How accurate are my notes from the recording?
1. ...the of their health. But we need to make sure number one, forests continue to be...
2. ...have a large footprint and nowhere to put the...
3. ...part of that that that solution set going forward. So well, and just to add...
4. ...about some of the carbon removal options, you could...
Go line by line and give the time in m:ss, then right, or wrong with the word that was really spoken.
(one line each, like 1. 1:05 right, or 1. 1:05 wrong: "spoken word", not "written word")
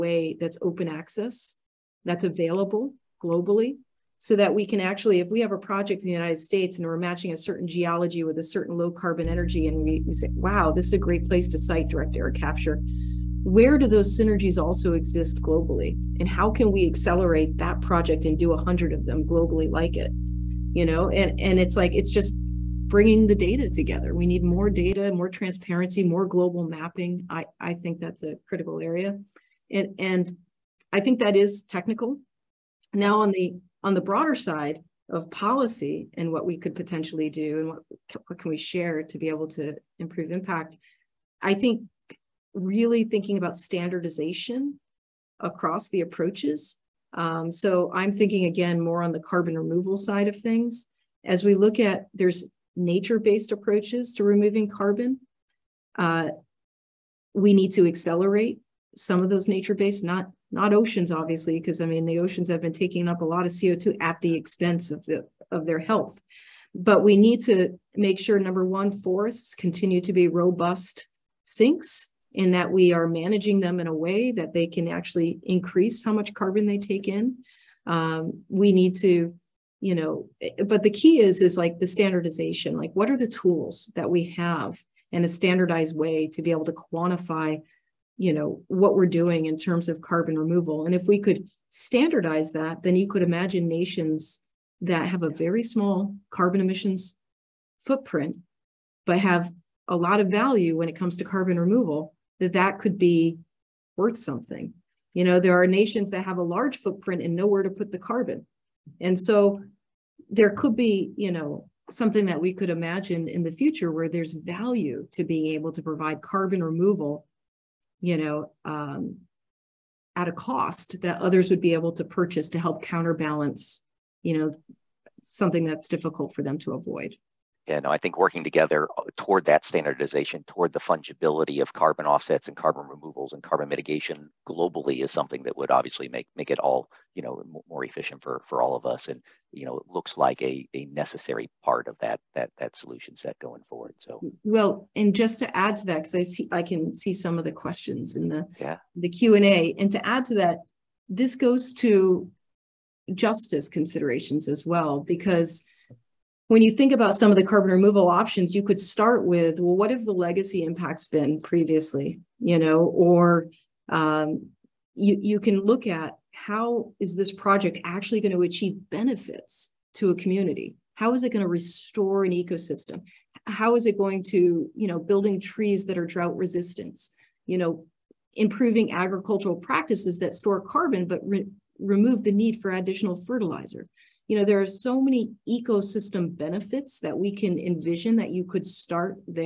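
1. 1:05 right
2. 1:46 right
3. 2:21 right
4. 2:36 right.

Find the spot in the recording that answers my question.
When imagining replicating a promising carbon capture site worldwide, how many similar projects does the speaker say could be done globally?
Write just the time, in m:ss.
0:18.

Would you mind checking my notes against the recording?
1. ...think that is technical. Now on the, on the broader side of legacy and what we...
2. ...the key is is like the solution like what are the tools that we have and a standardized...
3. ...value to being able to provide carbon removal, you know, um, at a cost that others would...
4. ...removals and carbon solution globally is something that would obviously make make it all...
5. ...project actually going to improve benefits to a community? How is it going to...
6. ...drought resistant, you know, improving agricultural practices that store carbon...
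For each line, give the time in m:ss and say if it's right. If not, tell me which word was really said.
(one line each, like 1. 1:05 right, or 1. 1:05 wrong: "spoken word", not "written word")
1. 0:30 wrong: "policy", not "legacy"
2. 1:20 wrong: "standardization", not "solution"
3. 1:54 right
4. 2:12 wrong: "mitigation", not "solution"
5. 2:47 wrong: "achieve", not "improve"
6. 2:56 right.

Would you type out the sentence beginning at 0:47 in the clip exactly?
Um, so I'm thinking again more on the carbon removal side of things.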